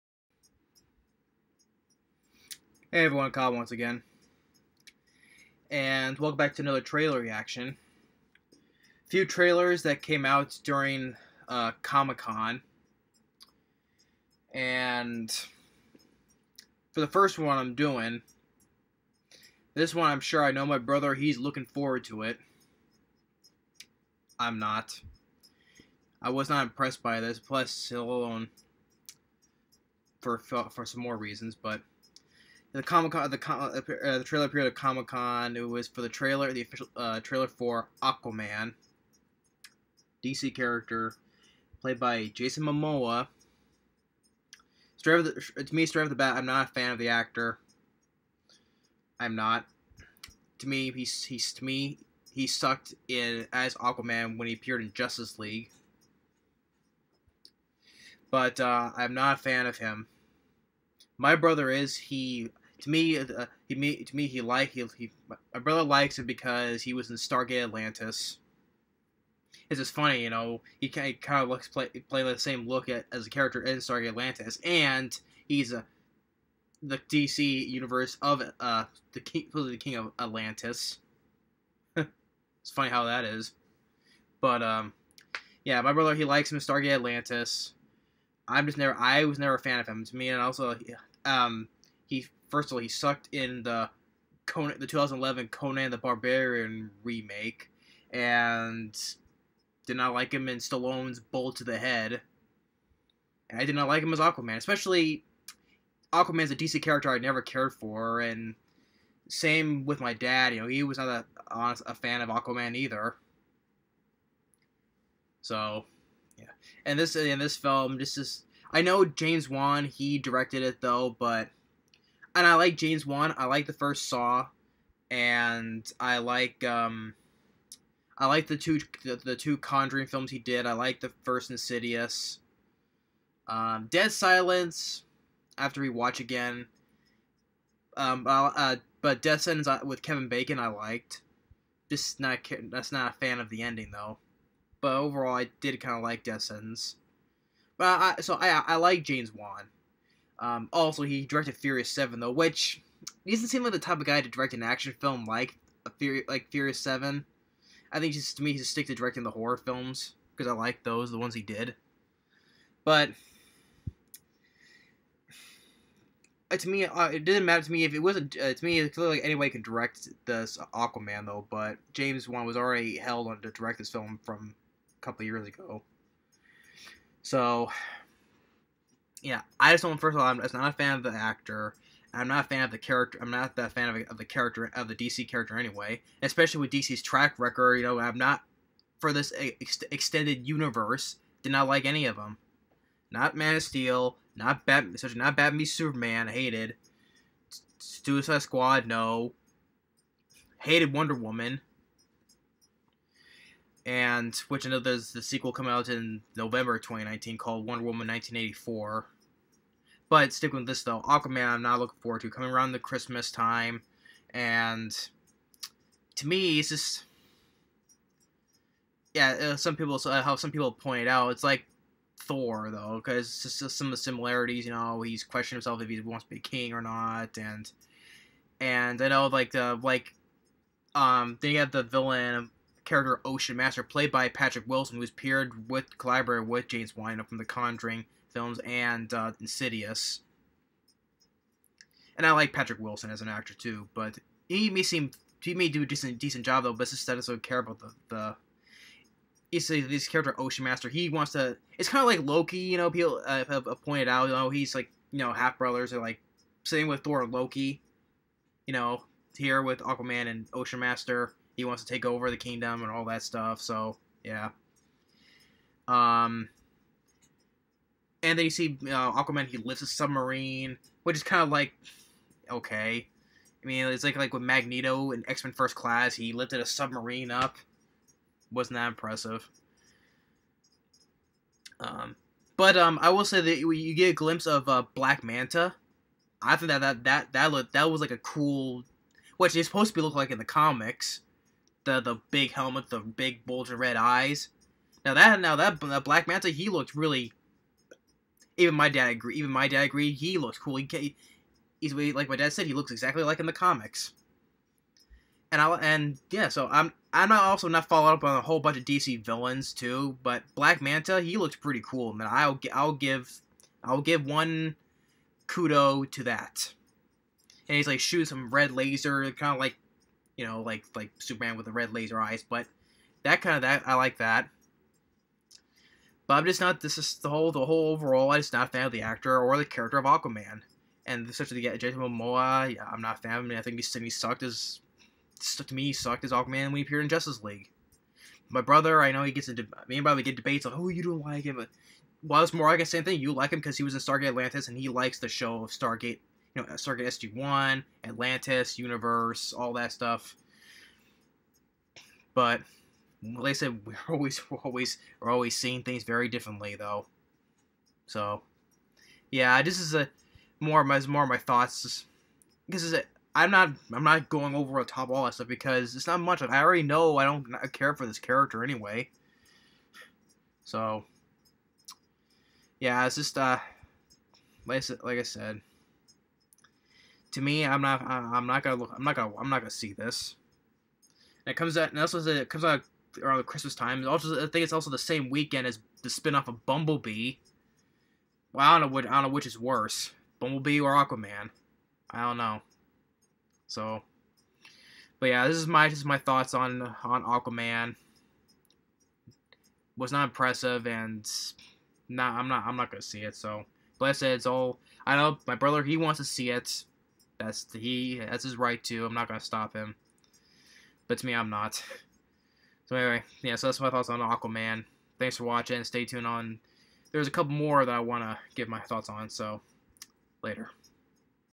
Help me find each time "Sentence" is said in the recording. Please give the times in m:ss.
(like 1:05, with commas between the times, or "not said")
2:19, 2:26.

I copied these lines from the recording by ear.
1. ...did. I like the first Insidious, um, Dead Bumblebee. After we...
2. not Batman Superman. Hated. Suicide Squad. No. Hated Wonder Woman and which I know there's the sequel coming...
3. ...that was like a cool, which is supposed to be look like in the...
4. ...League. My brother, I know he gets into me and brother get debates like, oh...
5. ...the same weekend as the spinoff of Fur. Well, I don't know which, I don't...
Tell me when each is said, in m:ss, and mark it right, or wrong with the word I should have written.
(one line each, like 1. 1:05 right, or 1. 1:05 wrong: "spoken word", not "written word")
1. 2:10 wrong: "Silence", not "Bumblebee"
2. 3:15 right
3. 4:47 right
4. 5:37 right
5. 6:24 wrong: "Bumblebee", not "Fur".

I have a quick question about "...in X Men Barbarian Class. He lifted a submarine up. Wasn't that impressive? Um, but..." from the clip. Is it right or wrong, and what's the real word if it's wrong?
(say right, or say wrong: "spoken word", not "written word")
wrong: "First", not "Barbarian".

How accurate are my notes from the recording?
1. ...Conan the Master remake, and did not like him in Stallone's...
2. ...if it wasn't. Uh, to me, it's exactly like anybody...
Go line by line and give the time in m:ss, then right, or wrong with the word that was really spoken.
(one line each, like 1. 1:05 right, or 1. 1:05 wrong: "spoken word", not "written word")
1. 1:35 wrong: "Barbarian", not "Master"
2. 2:47 wrong: "clearly", not "exactly".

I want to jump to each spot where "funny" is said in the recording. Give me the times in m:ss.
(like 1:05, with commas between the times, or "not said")
1:09, 1:22.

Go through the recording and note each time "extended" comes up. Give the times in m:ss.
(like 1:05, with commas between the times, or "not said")
3:09.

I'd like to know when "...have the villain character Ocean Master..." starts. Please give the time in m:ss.
3:51.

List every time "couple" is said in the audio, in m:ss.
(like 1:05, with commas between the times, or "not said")
2:55, 6:57.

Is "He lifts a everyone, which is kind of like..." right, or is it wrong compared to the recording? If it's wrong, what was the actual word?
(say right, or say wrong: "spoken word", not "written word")
wrong: "submarine", not "everyone".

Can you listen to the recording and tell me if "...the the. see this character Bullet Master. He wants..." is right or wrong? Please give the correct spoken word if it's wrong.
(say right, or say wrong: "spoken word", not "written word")
wrong: "Ocean", not "Bullet".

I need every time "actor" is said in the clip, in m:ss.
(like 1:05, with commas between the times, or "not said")
0:47, 3:01, 4:03, 5:29.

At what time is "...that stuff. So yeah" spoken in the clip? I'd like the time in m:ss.
4:23.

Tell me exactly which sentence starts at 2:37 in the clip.
I think just to me, he's stick to directing the horror films because I like those, the ones he did.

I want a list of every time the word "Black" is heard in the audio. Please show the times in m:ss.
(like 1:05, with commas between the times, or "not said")
4:44, 4:56, 5:10.